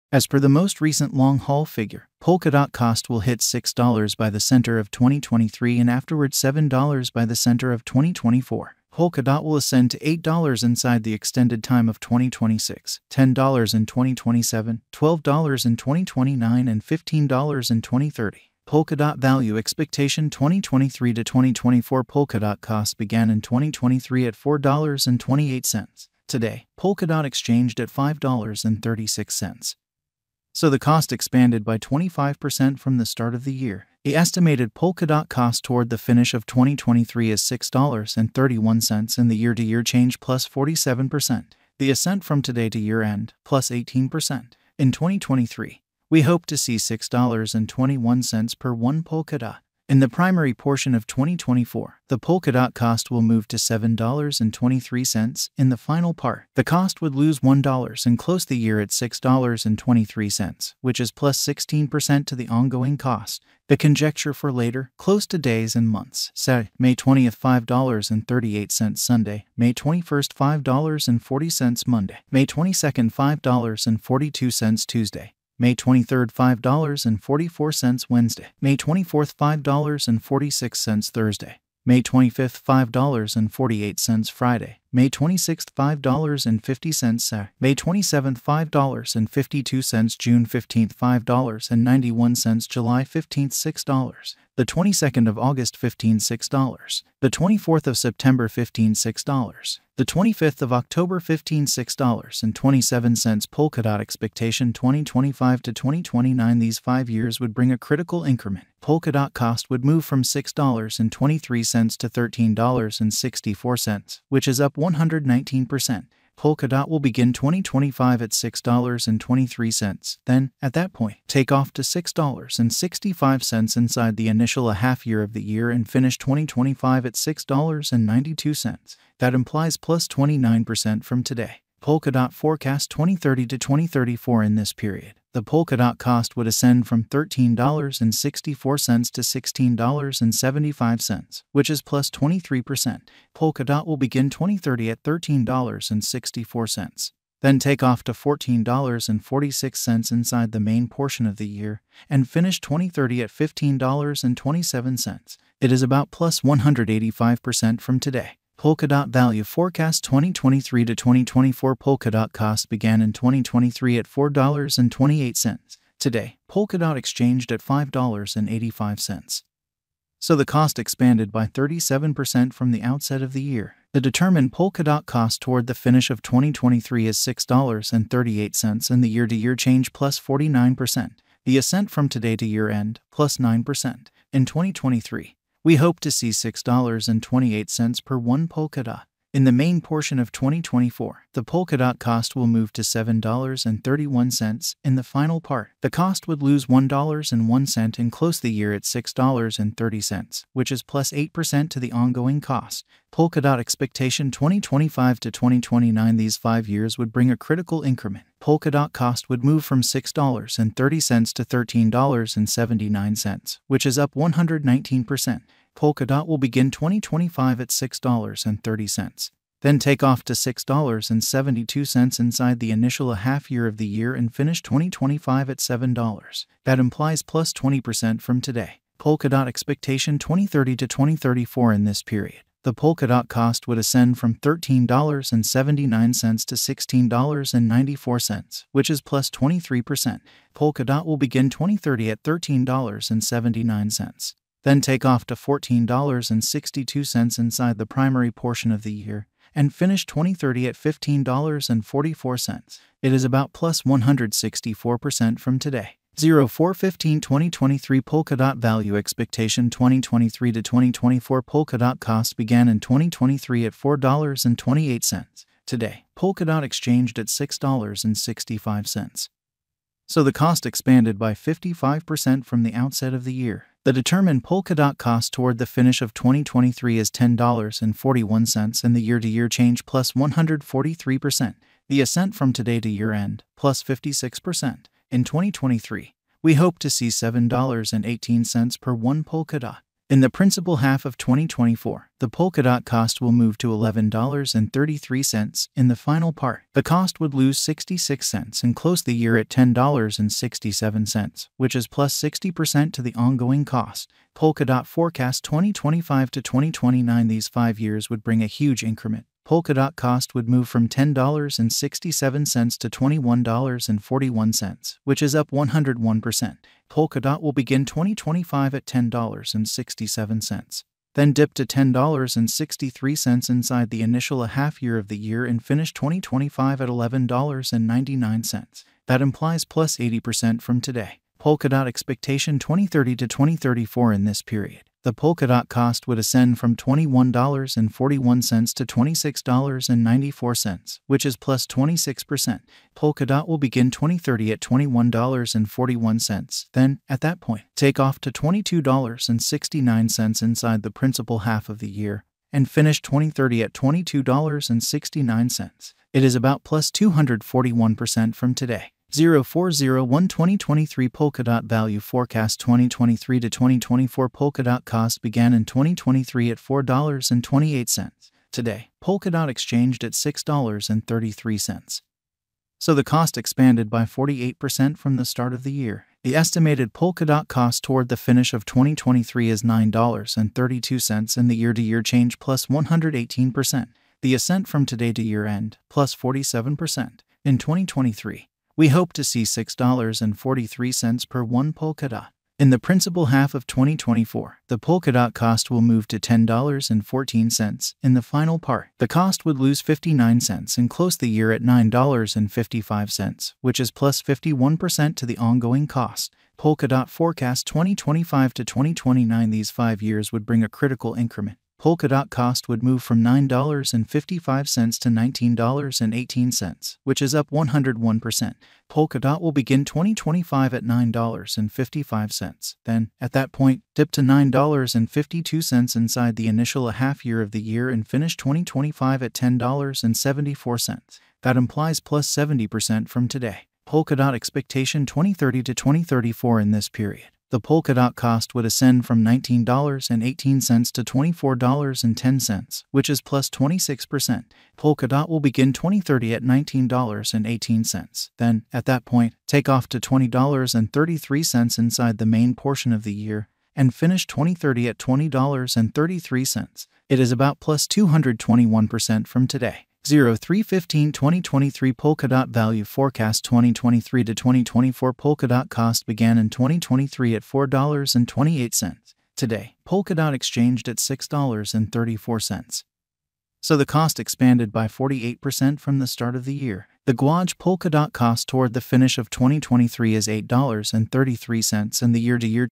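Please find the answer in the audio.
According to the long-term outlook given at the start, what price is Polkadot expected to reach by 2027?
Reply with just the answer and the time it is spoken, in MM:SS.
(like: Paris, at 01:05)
$10, at 00:13.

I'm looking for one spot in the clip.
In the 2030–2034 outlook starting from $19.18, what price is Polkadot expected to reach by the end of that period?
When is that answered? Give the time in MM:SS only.
07:21.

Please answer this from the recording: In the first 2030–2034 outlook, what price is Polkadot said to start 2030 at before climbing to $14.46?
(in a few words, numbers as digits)
$13.64.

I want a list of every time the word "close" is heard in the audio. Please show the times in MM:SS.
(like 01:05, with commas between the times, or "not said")
00:58, 01:04, 03:18, 04:58, 06:40.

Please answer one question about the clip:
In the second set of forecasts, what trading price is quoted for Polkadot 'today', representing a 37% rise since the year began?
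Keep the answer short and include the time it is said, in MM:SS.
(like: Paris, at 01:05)
$5.85, at 02:46.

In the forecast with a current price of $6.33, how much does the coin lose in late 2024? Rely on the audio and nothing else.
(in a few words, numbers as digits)
59 cents.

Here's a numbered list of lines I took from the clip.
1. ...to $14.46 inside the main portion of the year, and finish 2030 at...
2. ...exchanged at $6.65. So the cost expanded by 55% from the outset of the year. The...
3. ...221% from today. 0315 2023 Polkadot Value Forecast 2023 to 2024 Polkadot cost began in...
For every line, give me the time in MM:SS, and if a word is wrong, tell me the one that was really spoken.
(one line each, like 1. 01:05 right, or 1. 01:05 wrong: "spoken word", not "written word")
1. 02:28 right
2. 04:26 right
3. 07:37 right.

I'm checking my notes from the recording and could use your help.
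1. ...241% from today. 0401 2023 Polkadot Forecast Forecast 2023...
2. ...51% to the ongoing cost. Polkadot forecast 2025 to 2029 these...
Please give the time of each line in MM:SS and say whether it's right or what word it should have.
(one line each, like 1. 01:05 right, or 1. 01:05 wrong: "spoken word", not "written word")
1. 05:56 wrong: "Value", not "Forecast"
2. 06:44 right.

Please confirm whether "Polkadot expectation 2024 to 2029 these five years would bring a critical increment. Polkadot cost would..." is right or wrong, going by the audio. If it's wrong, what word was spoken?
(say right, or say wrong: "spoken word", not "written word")
wrong: "2025", not "2024".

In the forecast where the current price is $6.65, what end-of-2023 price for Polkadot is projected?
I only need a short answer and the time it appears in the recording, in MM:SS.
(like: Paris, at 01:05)
$10.41, at 04:37.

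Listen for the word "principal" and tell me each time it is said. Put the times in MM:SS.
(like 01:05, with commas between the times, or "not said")
04:50, 05:50, 06:32.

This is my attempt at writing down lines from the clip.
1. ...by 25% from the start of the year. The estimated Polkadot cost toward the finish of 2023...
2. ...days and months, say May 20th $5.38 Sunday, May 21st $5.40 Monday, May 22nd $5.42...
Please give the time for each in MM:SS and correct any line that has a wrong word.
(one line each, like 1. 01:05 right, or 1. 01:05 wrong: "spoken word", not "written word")
1. 00:31 right
2. 01:05 right.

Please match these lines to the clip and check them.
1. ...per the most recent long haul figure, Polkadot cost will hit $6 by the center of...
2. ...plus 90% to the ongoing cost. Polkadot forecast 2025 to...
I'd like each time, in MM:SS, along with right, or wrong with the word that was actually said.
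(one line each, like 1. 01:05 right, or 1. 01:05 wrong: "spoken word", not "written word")
1. 00:00 right
2. 05:01 wrong: "60", not "90".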